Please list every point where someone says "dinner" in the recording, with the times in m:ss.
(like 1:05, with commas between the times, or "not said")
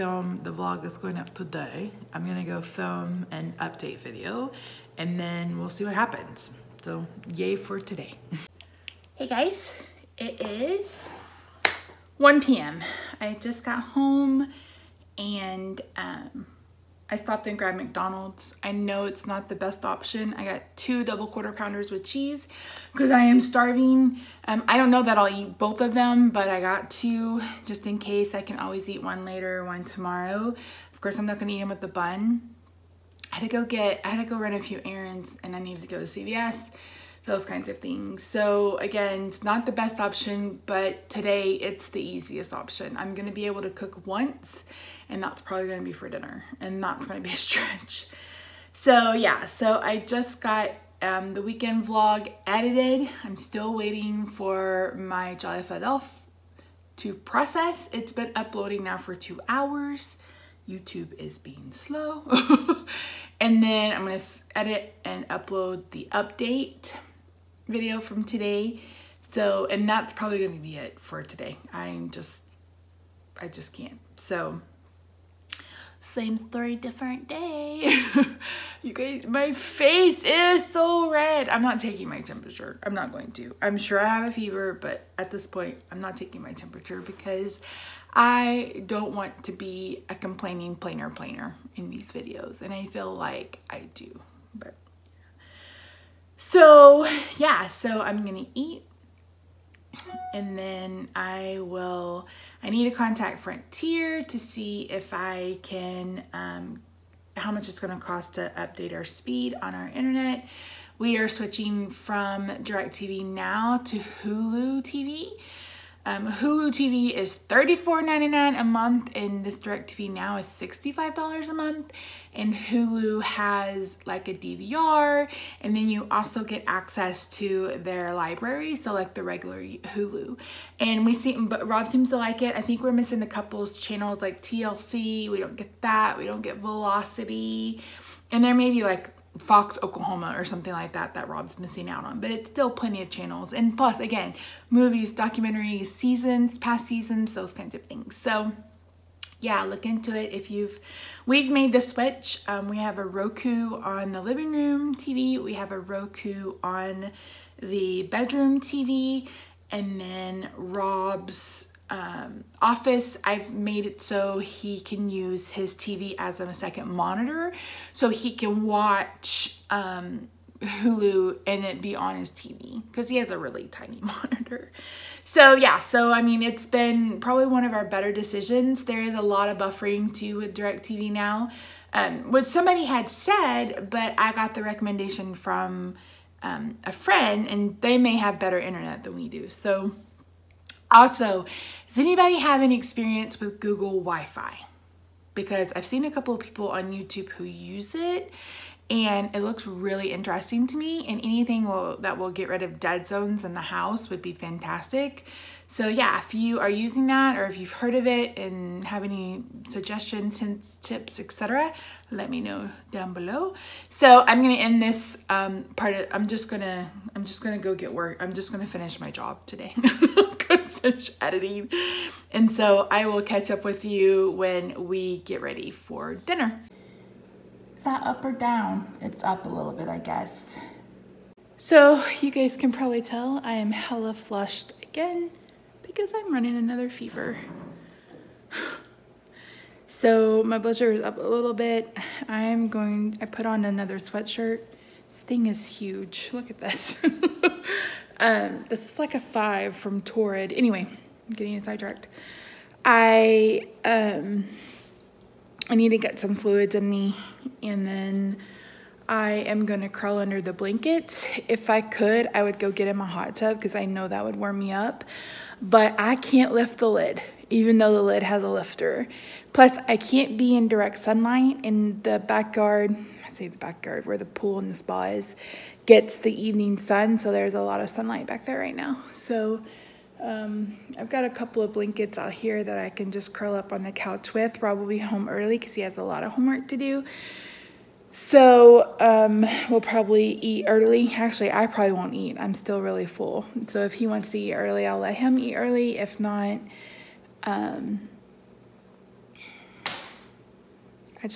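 0:46, 3:46.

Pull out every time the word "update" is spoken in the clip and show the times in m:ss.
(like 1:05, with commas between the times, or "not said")
0:03, 1:06, 1:48.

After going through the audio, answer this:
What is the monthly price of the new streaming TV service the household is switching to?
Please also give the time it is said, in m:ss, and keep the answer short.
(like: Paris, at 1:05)
$34.99, at 1:57.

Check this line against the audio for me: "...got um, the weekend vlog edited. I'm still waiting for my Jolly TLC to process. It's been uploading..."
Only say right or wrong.
wrong.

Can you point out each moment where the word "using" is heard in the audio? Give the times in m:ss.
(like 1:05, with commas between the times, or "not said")
3:26.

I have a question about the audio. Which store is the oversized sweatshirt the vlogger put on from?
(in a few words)
Torrid.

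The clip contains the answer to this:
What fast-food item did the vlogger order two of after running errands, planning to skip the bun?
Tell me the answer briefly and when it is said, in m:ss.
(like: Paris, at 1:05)
double quarter pounders with cheese, at 0:21.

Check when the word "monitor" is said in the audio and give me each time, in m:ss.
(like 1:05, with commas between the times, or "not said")
2:46, 2:53.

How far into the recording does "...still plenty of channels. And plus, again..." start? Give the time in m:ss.
2:22.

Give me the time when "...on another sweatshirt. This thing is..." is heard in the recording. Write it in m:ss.
4:03.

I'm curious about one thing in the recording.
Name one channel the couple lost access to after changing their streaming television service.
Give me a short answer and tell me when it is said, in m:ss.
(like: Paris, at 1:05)
TLC, at 2:14.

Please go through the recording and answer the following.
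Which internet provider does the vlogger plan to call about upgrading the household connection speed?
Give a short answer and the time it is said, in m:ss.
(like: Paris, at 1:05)
Frontier, at 1:43.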